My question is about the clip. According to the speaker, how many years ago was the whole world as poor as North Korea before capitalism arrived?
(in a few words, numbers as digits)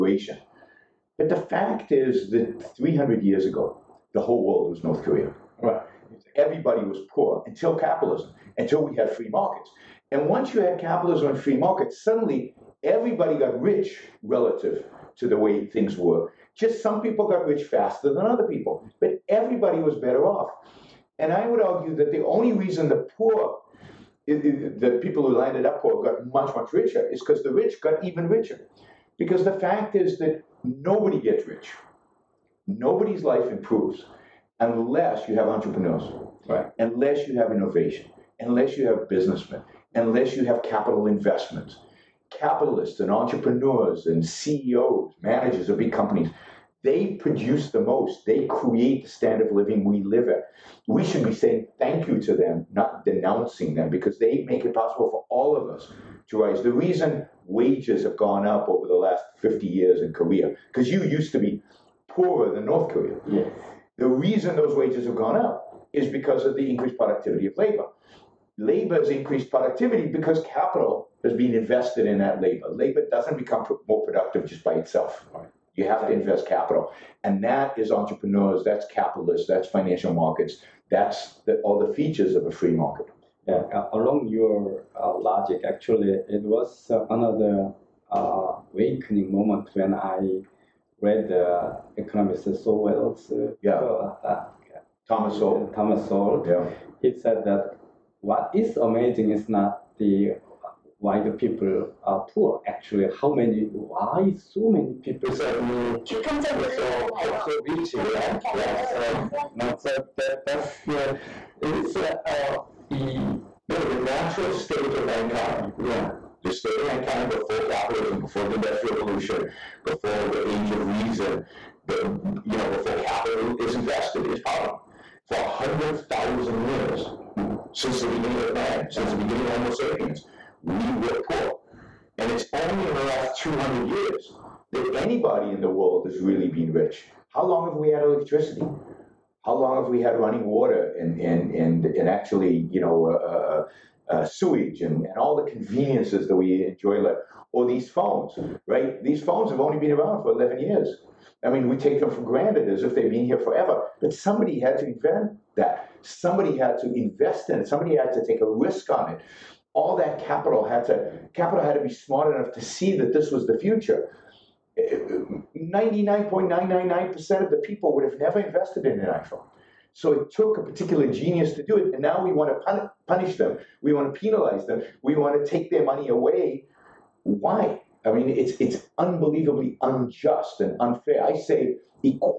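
300.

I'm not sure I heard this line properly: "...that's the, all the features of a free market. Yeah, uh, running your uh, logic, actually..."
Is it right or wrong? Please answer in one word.
wrong.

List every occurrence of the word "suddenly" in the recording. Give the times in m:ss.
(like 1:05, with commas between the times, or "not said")
0:12, 1:45.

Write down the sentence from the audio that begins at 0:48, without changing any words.
They create the standard of living we live at.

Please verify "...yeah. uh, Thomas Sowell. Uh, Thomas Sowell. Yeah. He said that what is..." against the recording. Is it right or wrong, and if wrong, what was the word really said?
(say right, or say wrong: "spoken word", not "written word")
right.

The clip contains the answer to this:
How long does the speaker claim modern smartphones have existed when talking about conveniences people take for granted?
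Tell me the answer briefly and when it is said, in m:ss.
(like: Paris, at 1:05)
11 years, at 2:30.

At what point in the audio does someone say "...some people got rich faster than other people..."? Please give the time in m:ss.
0:16.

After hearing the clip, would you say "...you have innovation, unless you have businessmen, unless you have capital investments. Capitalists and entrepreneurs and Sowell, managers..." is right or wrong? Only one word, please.
wrong.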